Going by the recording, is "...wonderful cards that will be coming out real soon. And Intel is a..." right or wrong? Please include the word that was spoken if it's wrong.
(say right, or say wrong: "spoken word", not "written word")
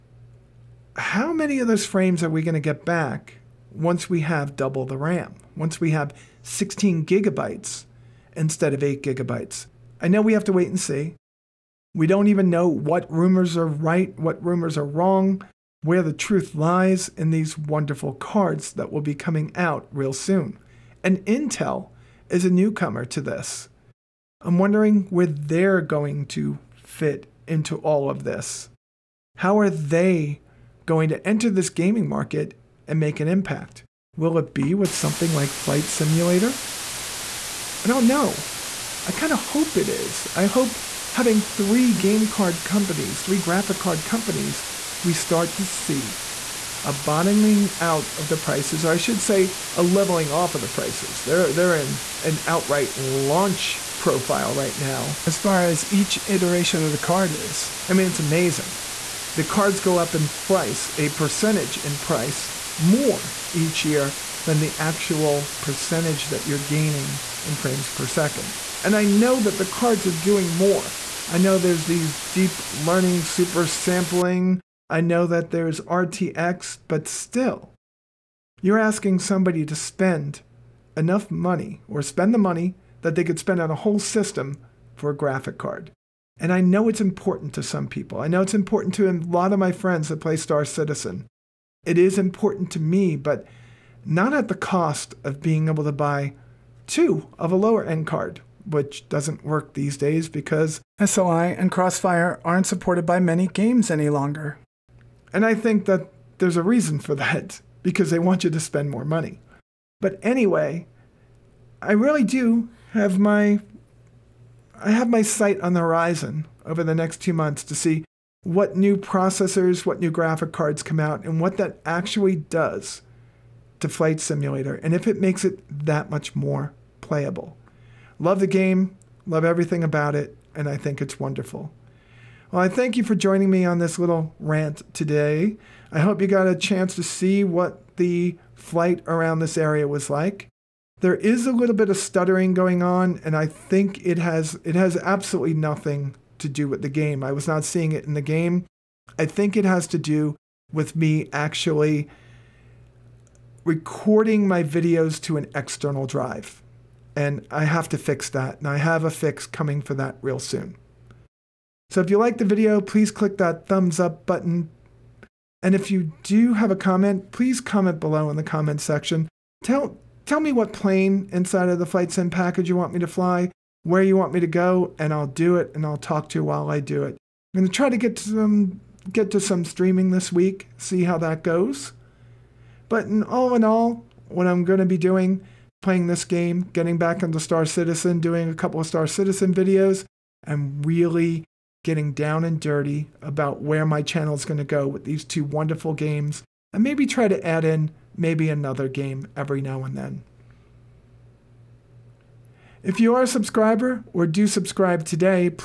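right.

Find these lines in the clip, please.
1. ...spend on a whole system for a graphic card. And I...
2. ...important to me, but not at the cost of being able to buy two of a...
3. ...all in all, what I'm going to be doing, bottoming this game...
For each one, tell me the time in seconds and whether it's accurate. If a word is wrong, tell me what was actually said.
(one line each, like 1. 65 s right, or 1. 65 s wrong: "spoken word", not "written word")
1. 83 s right
2. 92 s right
3. 183 s wrong: "playing", not "bottoming".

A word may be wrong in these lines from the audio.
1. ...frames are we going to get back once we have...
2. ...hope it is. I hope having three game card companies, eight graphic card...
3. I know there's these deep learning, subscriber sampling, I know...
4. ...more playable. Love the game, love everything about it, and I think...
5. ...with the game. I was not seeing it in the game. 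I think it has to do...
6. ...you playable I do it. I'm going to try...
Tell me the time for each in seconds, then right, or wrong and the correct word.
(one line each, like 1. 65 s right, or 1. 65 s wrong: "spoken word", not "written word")
1. 1 s right
2. 39 s wrong: "three", not "eight"
3. 71 s wrong: "super", not "subscriber"
4. 126 s right
5. 146 s right
6. 176 s wrong: "while", not "playable".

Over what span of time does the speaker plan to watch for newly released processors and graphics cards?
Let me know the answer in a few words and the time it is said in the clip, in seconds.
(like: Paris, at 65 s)
2 months, at 117 s.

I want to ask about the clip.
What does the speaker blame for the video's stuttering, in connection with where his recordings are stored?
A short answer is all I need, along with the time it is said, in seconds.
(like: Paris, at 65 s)
An external drive, at 155 s.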